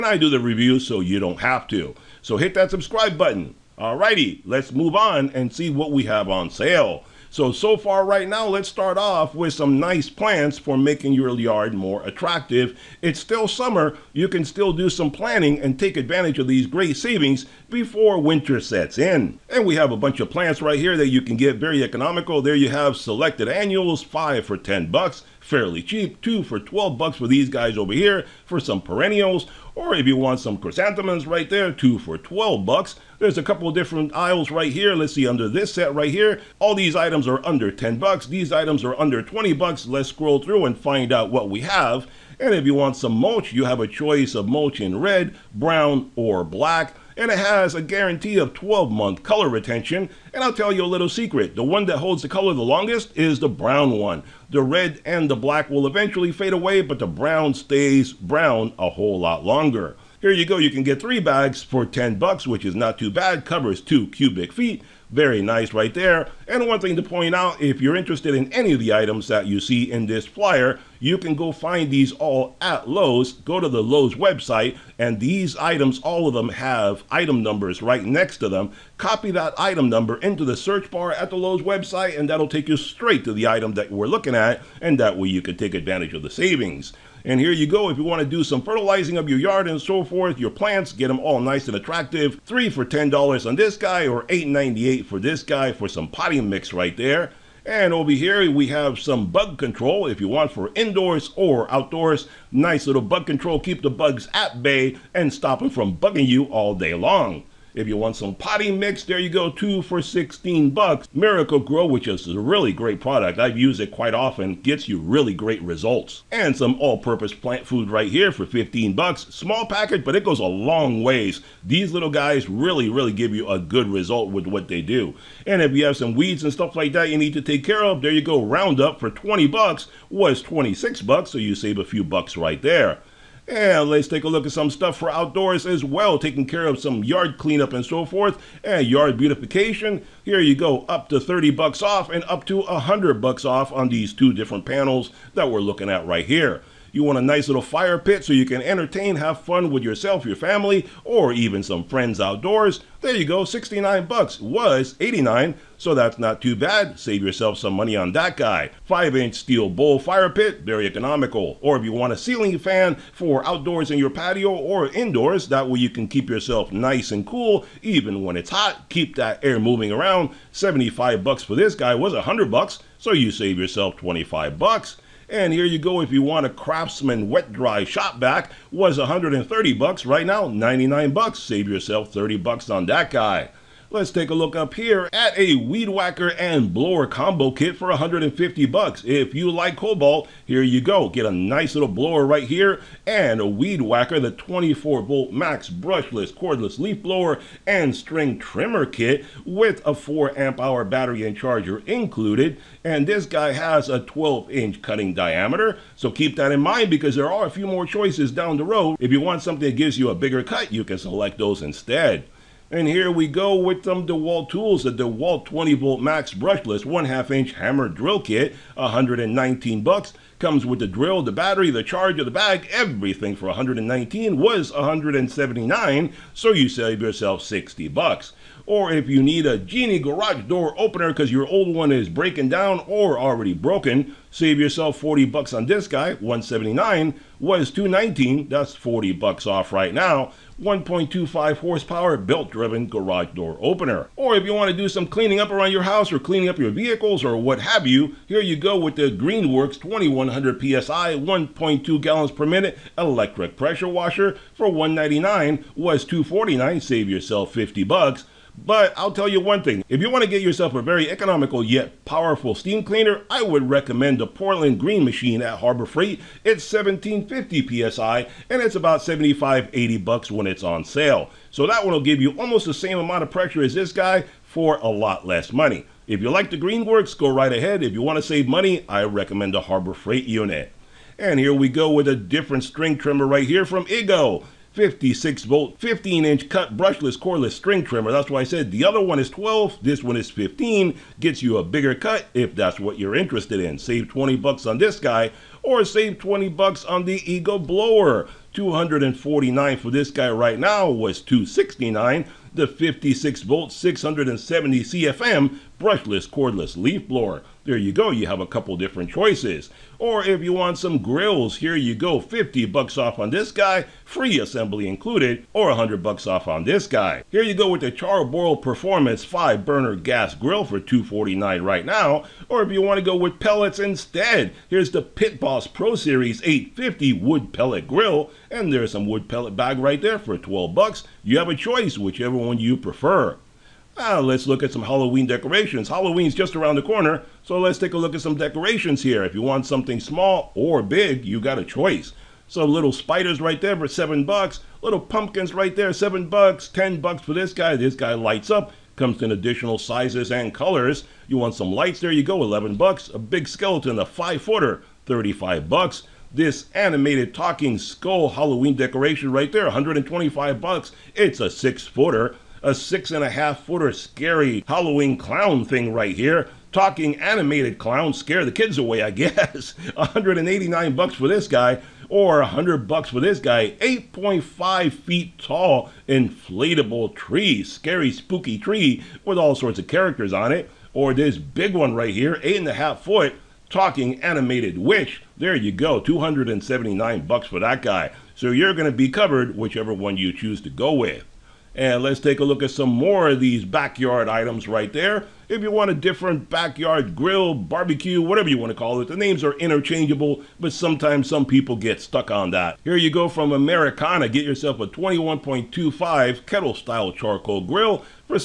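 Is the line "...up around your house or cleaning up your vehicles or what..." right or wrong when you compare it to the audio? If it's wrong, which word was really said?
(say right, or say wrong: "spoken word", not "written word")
right.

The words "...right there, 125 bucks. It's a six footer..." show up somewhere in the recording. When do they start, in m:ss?
5:59.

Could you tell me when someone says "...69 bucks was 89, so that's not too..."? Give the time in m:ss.
2:33.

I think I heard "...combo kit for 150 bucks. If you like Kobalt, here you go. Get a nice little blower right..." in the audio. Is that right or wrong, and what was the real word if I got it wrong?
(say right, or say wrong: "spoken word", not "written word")
right.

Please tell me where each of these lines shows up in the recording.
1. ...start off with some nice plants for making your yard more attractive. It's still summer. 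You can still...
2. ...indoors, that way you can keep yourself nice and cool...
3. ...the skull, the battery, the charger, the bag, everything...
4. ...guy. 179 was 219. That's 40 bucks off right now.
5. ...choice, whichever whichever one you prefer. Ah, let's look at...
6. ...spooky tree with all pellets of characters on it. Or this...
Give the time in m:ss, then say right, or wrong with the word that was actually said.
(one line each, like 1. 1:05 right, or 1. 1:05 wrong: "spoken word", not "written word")
1. 0:08 right
2. 2:44 right
3. 3:40 wrong: "drill", not "skull"
4. 3:55 right
5. 5:31 right
6. 6:18 wrong: "sorts", not "pellets".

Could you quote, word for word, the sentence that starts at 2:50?
75 bucks for this guy was 100 bucks, so you save yourself 25 bucks.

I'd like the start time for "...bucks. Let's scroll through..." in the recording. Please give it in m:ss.
0:39.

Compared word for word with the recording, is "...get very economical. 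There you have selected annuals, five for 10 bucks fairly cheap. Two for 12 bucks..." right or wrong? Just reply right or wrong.
right.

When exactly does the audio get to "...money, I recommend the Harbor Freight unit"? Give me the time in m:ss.
4:38.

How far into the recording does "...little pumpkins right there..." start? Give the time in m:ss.
5:44.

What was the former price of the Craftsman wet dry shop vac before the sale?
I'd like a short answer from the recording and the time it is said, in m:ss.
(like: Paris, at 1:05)
$130, at 2:58.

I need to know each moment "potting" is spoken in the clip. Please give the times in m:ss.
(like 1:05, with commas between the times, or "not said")
1:36, 1:48.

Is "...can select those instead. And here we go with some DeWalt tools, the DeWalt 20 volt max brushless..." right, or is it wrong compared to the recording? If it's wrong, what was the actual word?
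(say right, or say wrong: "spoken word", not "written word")
right.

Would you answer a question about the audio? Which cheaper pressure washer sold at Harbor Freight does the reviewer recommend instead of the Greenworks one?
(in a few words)
Portland Green Machine.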